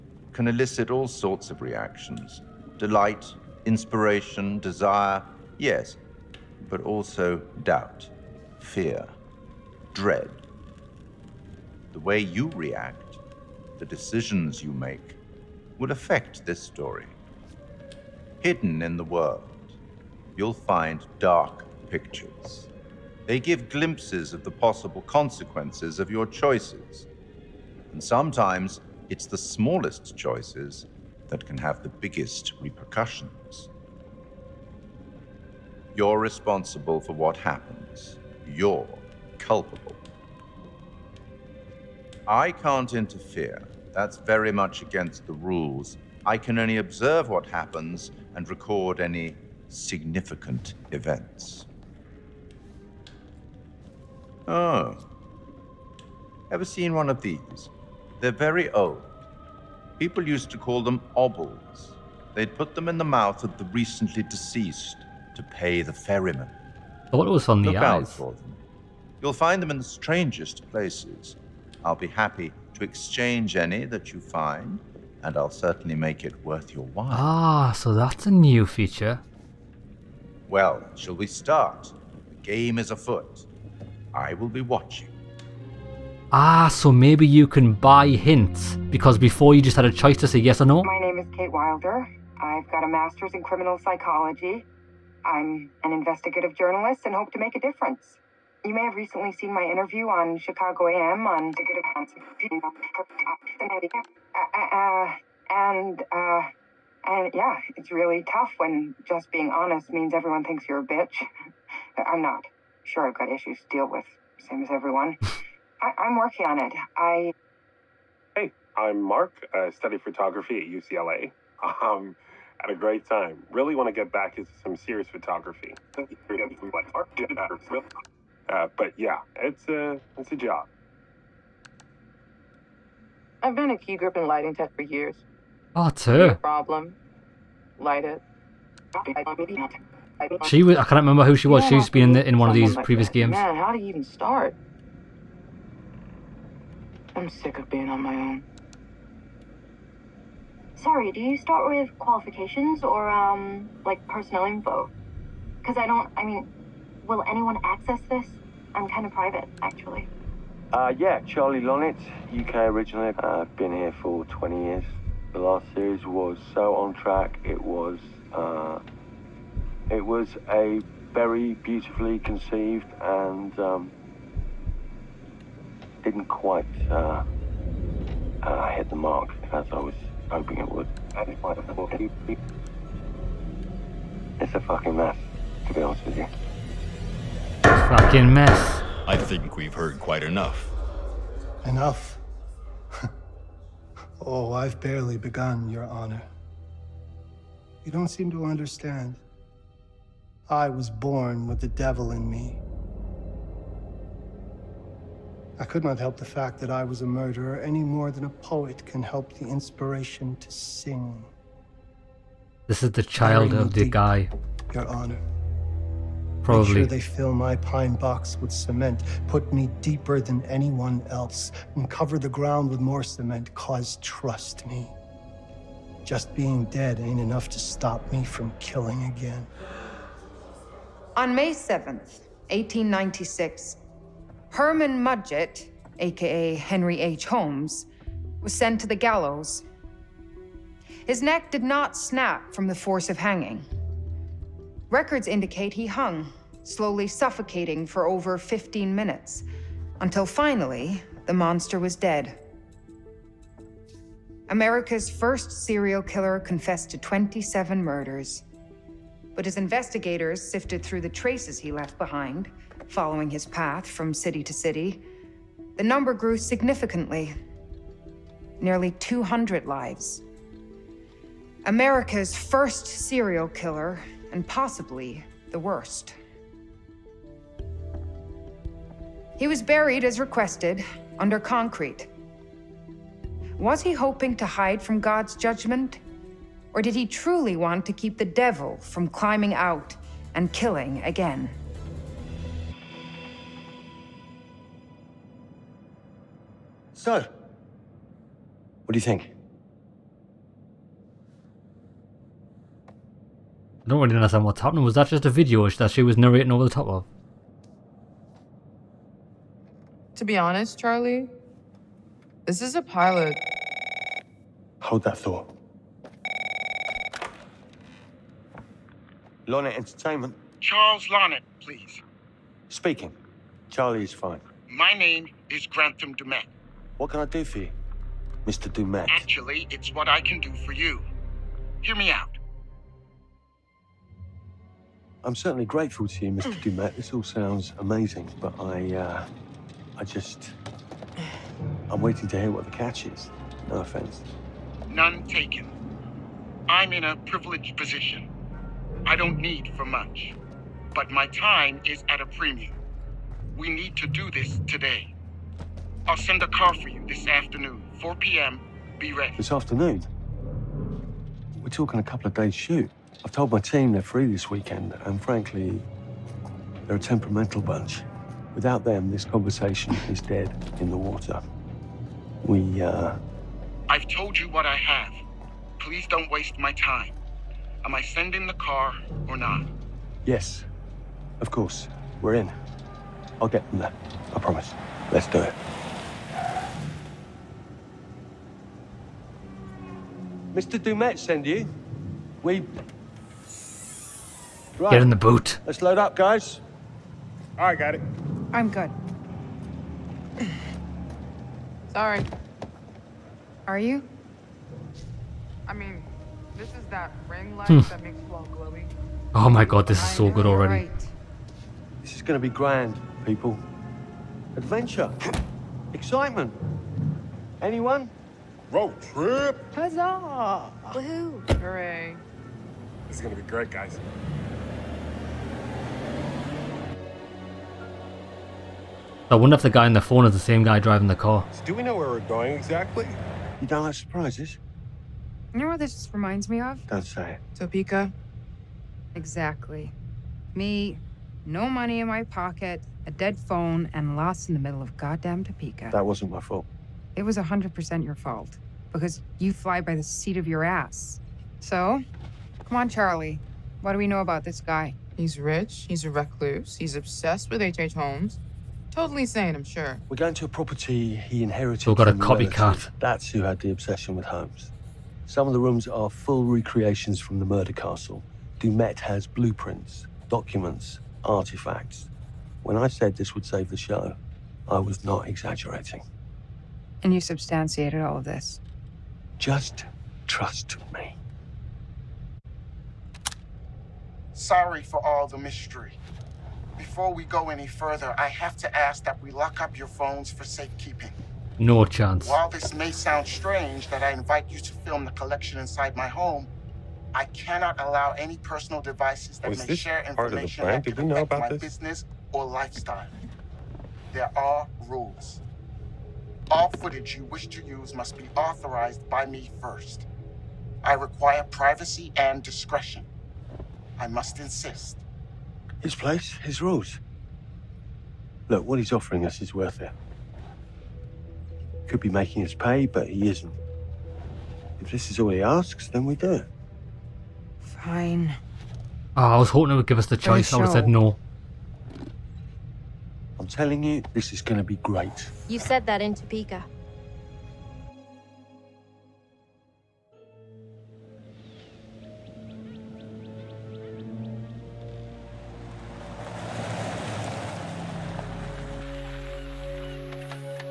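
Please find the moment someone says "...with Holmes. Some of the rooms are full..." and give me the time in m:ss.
7:44.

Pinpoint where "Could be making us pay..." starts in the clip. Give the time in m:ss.
8:41.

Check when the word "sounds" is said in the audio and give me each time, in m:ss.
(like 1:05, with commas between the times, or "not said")
5:37, 8:12.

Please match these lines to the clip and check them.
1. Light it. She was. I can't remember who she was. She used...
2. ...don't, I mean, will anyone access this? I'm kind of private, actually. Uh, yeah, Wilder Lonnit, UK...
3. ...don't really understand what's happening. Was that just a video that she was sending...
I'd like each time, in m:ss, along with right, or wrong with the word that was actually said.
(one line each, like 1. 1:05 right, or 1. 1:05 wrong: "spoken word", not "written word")
1. 2:17 right
2. 2:35 wrong: "Charlie", not "Wilder"
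3. 5:03 wrong: "narrating", not "sending".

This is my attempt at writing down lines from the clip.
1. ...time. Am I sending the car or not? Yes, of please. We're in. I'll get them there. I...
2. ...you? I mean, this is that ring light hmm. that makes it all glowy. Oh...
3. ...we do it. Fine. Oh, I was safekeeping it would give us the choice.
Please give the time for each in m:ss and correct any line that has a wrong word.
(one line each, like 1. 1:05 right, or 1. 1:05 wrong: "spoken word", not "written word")
1. 6:16 wrong: "course", not "please"
2. 6:43 right
3. 8:46 wrong: "hoping", not "safekeeping".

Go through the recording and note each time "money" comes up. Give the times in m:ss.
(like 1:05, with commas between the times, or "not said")
7:21.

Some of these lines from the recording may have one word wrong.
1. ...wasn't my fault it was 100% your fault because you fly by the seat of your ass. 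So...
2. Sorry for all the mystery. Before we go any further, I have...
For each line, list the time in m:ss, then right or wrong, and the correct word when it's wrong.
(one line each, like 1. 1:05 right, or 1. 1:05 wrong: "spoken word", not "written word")
1. 7:26 right
2. 8:04 right.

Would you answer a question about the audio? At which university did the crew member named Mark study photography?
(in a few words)
UCLA.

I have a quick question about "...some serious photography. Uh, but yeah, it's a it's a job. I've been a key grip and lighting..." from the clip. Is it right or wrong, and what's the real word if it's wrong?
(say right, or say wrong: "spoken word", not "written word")
right.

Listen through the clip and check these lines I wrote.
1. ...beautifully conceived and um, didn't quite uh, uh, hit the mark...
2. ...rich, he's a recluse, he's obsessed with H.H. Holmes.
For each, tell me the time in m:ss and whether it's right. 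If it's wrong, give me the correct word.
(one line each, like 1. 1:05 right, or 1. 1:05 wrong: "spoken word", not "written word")
1. 2:51 right
2. 7:35 right.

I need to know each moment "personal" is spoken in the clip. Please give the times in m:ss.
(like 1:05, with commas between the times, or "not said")
2:34, 8:18.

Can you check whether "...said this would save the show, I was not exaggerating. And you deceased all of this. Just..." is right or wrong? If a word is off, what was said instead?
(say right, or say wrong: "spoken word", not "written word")
wrong: "substantiated", not "deceased".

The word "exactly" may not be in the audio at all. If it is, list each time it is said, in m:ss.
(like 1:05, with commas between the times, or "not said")
7:12, 7:19.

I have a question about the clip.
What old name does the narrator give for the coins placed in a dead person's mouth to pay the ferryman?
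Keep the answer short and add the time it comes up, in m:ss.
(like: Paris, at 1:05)
obols, at 1:01.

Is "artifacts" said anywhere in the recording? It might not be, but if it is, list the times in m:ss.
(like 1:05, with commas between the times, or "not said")
7:51.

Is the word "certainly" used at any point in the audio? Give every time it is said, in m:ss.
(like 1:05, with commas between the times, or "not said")
1:15, 5:35.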